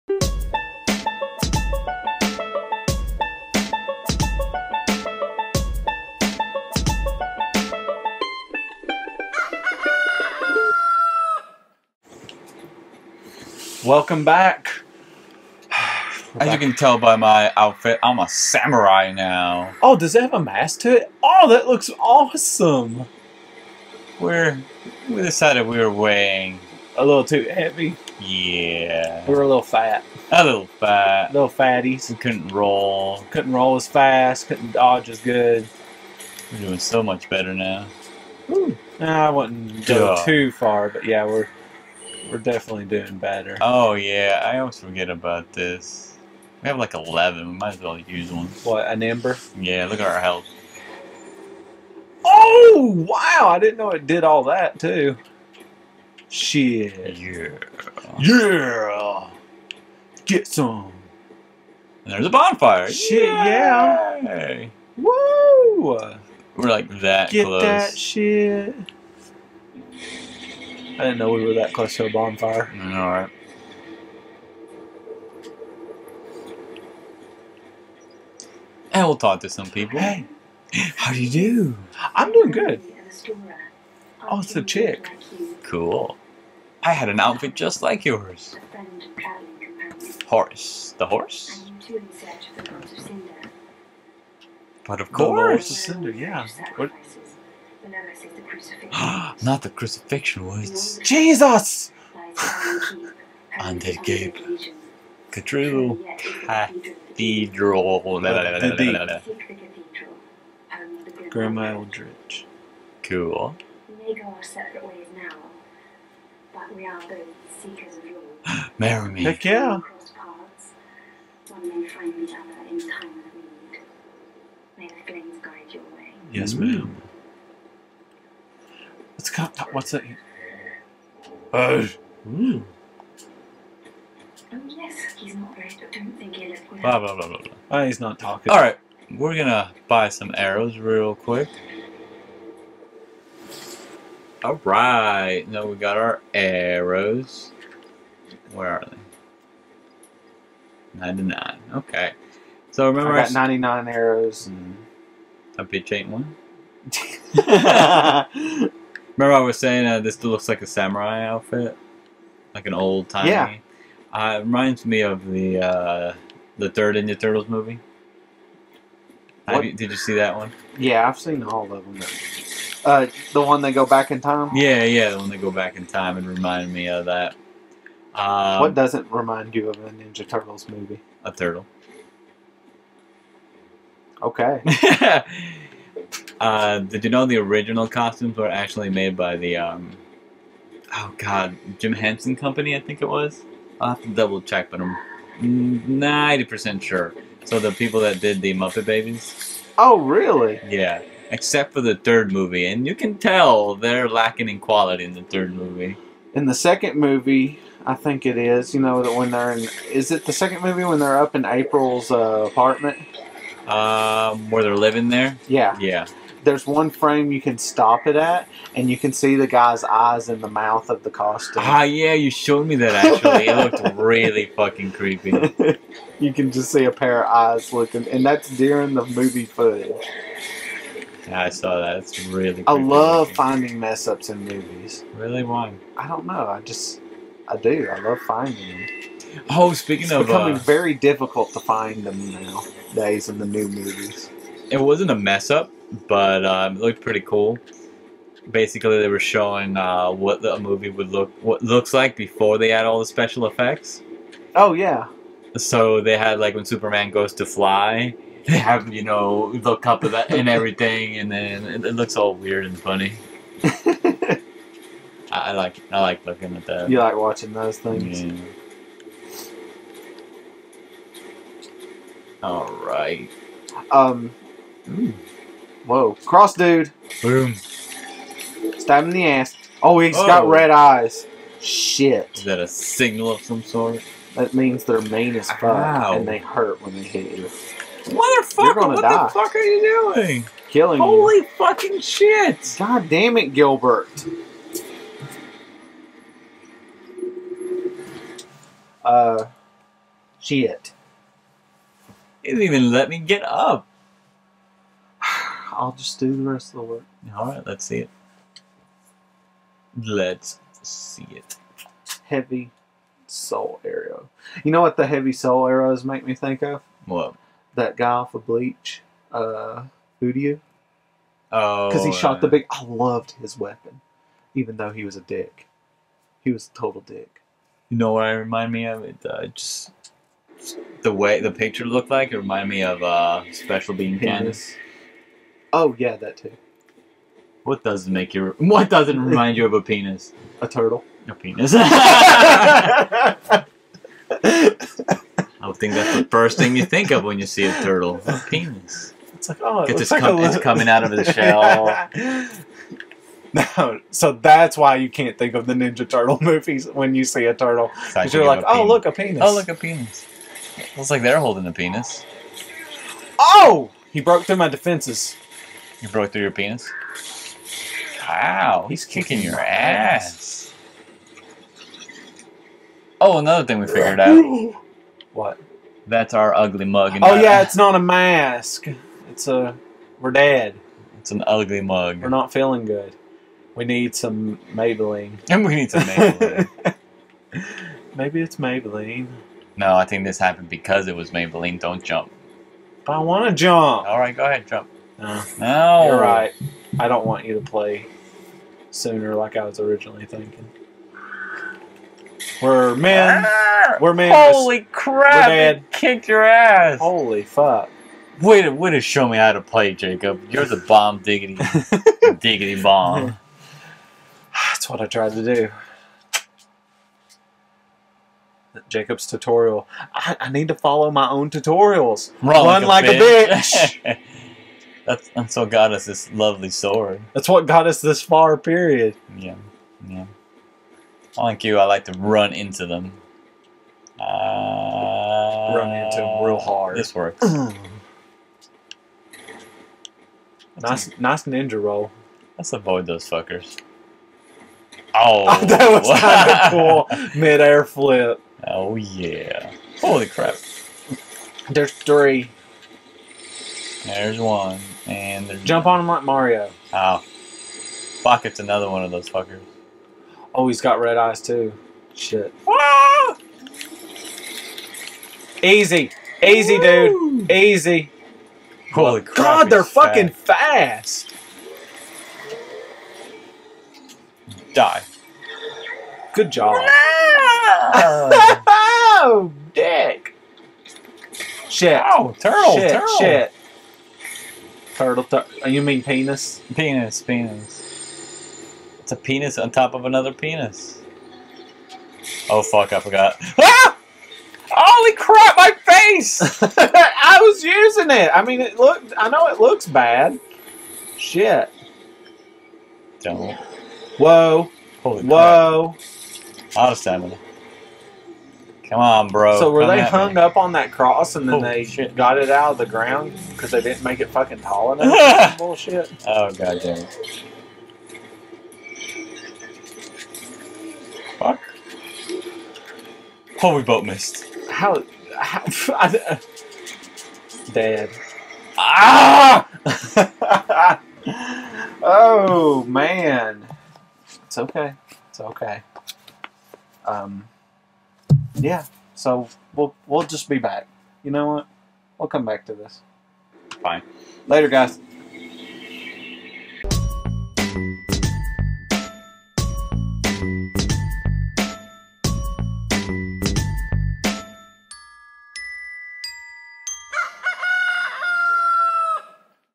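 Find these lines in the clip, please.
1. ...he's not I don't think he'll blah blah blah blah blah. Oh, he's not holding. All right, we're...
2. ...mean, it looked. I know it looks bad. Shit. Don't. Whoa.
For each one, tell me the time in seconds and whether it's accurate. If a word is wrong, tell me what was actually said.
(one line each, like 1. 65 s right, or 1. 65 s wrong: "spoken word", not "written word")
1. 134 s wrong: "talking", not "holding"
2. 498 s right.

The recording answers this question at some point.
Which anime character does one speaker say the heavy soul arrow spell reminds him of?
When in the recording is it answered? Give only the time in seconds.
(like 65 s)
318 s.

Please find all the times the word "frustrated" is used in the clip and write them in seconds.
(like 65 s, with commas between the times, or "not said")
not said.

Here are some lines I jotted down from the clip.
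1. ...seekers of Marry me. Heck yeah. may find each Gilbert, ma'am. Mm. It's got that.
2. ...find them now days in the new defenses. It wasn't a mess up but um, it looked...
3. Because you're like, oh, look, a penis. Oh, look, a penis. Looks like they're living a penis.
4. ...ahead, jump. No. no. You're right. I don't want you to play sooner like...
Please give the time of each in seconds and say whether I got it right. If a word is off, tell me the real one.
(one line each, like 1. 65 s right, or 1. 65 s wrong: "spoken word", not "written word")
1. 117 s wrong: "Yes", not "Gilbert"
2. 241 s wrong: "movies", not "defenses"
3. 358 s wrong: "holding", not "living"
4. 394 s right.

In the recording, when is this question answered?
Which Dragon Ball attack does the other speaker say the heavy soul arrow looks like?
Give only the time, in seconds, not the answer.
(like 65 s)
333 s.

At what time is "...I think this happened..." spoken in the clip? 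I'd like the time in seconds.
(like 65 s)
389 s.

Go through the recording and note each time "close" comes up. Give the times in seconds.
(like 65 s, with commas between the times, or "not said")
67 s, 71 s.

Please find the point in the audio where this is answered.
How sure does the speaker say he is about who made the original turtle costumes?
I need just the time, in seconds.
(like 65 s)
195 s.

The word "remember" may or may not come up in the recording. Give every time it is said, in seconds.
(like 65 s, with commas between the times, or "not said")
152 s, 159 s.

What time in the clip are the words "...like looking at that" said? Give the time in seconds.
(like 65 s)
266 s.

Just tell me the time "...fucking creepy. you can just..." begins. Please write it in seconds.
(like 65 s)
224 s.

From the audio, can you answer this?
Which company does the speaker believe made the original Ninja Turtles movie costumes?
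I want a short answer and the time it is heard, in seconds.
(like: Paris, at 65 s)
Jim Henson Company, at 191 s.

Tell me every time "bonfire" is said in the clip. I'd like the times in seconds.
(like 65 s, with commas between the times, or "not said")
62 s, 72 s.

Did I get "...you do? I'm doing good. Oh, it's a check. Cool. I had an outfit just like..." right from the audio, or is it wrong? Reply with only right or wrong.
wrong.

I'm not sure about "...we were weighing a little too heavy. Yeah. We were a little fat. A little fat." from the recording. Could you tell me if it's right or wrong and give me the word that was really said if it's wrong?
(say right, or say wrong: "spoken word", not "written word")
right.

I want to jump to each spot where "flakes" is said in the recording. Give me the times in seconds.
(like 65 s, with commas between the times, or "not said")
not said.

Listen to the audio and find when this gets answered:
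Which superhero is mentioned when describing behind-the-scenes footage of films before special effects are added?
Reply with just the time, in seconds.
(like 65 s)
256 s.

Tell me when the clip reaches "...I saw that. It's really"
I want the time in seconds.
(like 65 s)
231 s.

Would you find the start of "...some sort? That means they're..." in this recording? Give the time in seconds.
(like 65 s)
283 s.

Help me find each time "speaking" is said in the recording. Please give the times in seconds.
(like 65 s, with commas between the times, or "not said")
239 s.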